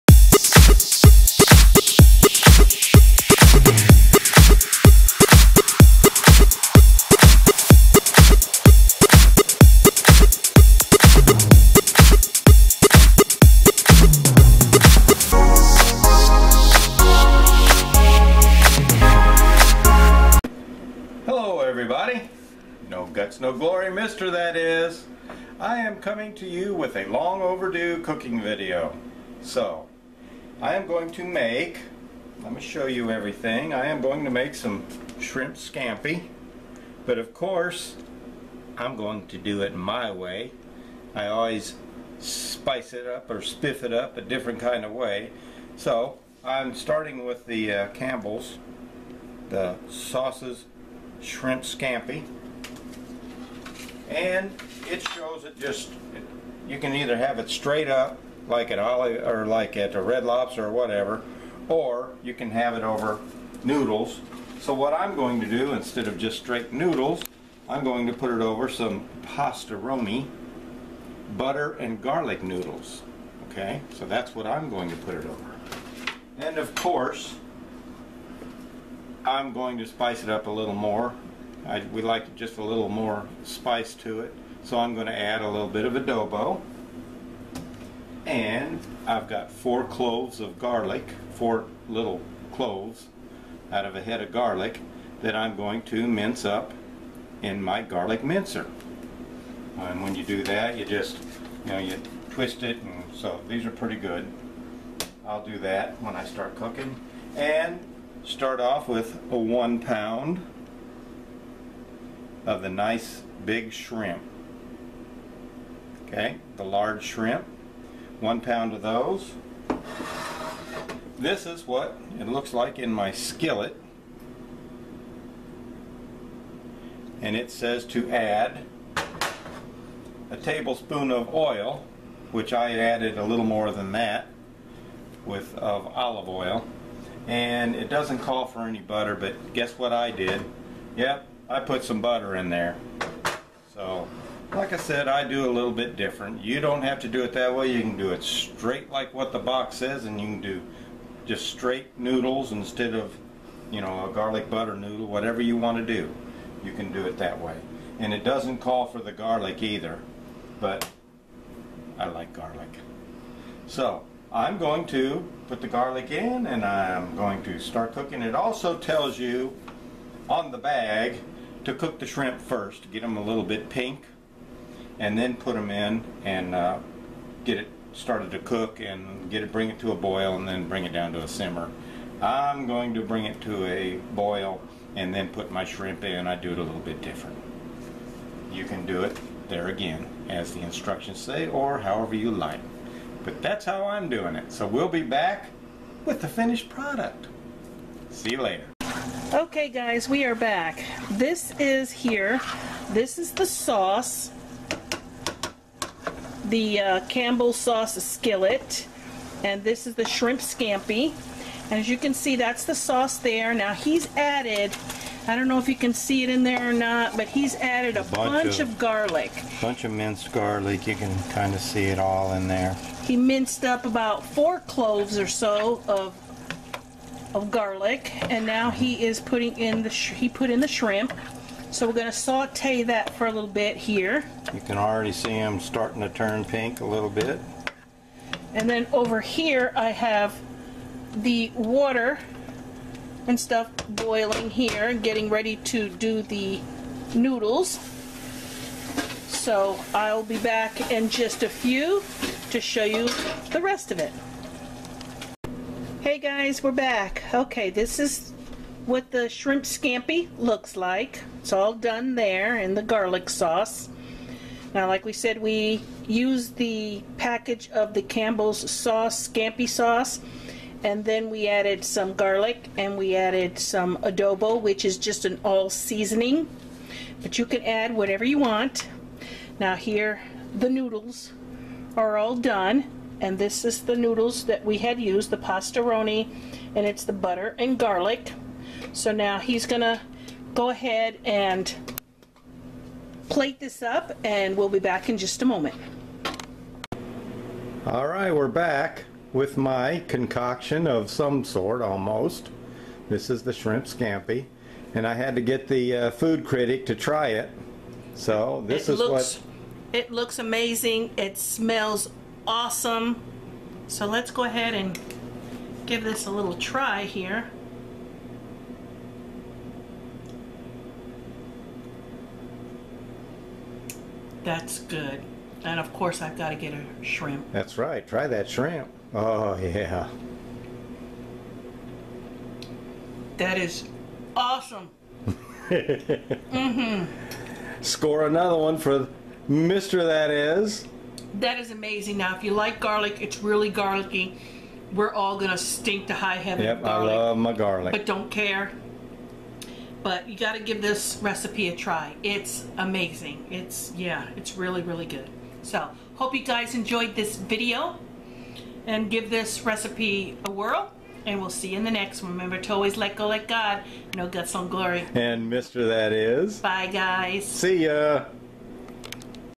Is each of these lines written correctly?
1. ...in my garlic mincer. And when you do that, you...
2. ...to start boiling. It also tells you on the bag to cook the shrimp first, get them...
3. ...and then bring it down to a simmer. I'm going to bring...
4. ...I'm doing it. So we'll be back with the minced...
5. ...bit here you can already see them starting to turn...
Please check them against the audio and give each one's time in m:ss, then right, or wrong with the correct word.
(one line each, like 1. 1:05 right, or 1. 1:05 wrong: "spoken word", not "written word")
1. 1:37 right
2. 2:47 wrong: "cooking", not "boiling"
3. 3:00 right
4. 3:13 wrong: "finished", not "minced"
5. 3:53 right.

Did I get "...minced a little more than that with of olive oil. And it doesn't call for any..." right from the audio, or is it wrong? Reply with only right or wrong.
wrong.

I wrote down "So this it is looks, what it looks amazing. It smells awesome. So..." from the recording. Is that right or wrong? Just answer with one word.
right.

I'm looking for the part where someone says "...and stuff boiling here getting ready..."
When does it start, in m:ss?
4:03.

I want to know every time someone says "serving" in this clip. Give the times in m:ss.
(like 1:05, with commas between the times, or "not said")
not said.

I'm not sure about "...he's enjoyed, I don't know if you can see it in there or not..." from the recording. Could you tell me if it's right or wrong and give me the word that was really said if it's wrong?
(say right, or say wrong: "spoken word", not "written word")
wrong: "added", not "enjoyed".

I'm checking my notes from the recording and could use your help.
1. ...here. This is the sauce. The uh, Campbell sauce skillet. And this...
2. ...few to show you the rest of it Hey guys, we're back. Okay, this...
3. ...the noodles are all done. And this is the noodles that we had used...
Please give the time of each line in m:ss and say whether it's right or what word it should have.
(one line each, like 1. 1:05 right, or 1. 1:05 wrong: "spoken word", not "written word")
1. 3:21 right
2. 4:11 right
3. 4:40 right.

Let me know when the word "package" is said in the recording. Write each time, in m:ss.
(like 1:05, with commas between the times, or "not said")
4:27.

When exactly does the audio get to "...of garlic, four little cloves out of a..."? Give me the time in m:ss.
1:30.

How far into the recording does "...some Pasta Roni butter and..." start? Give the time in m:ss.
1:08.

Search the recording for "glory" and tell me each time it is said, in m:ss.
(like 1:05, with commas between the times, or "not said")
0:23, 6:04.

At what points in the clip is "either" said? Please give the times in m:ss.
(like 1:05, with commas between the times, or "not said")
0:56, 2:39.